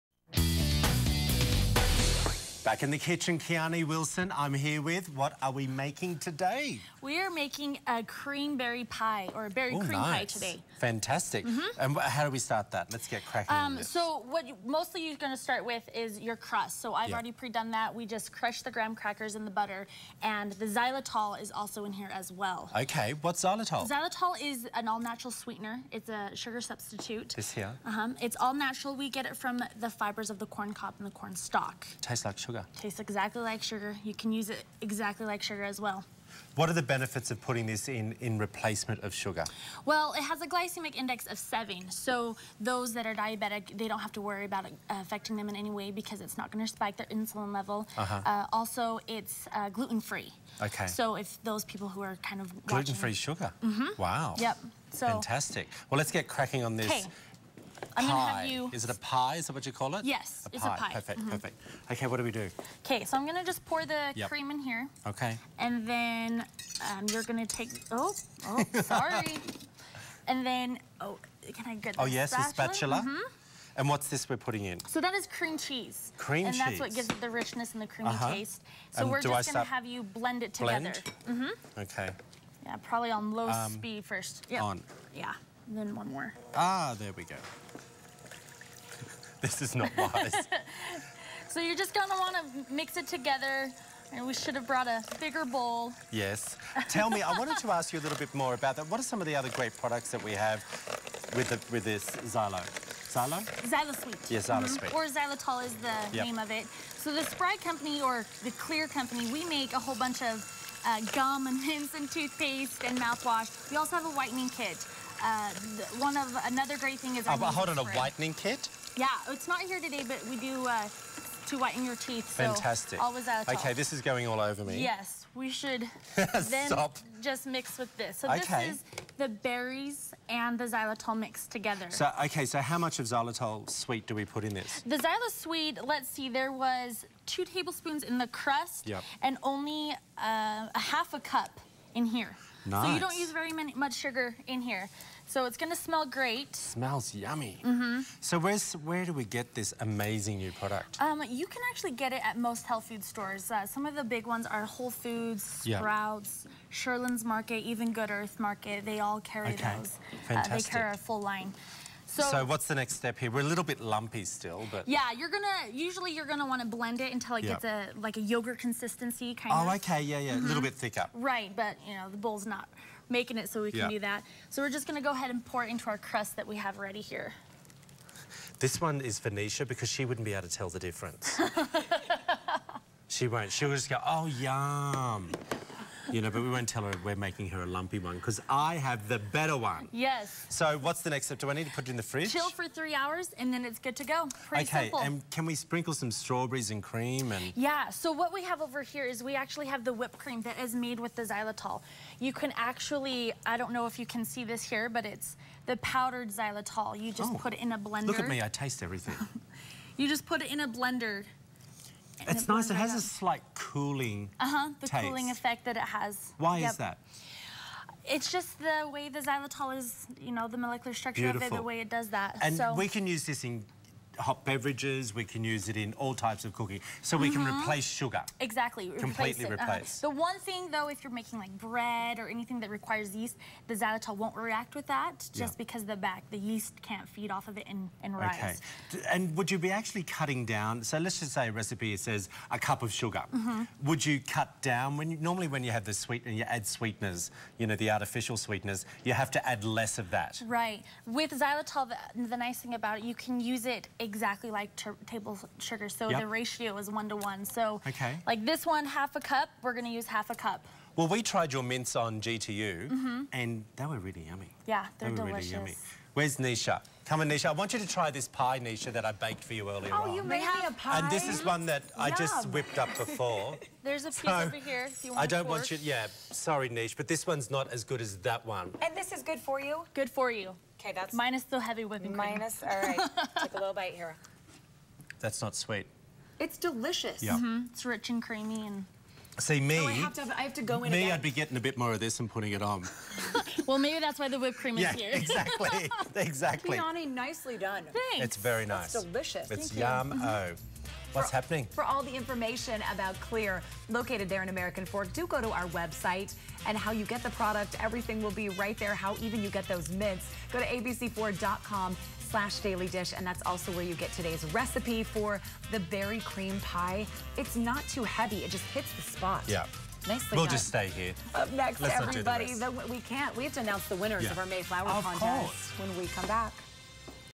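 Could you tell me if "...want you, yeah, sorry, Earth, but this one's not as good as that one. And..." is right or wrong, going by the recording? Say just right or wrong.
wrong.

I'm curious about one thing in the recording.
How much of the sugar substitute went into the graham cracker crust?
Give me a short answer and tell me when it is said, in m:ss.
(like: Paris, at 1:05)
2 tablespoons, at 2:17.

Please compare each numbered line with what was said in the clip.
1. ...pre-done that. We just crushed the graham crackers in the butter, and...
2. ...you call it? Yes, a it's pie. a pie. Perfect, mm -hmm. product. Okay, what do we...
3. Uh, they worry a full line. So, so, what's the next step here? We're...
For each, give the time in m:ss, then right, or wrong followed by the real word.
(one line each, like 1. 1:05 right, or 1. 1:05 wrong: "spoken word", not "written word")
1. 0:17 right
2. 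0:59 wrong: "perfect", not "product"
3. 2:40 wrong: "carry", not "worry".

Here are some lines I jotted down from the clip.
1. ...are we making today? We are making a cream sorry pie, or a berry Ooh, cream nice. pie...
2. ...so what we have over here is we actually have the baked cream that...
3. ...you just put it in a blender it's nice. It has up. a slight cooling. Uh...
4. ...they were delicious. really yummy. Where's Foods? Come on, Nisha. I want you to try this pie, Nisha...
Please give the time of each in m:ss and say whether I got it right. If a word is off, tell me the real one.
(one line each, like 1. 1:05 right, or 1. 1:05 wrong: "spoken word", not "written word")
1. 0:05 wrong: "berry", not "sorry"
2. 3:17 wrong: "whipped", not "baked"
3. 3:29 right
4. 4:24 wrong: "Nisha", not "Foods".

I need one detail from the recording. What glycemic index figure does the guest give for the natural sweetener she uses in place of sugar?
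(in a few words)
7.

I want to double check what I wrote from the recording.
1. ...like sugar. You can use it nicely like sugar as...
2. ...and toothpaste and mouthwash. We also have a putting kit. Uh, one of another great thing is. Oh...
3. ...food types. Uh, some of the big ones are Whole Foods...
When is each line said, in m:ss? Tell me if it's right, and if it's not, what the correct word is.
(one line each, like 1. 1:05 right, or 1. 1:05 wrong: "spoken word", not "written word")
1. 0:33 wrong: "exactly", not "nicely"
2. 1:51 wrong: "whitening", not "putting"
3. 2:32 wrong: "stores", not "types".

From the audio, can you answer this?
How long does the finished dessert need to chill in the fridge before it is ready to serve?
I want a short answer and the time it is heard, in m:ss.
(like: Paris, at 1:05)
3 hours, at 3:12.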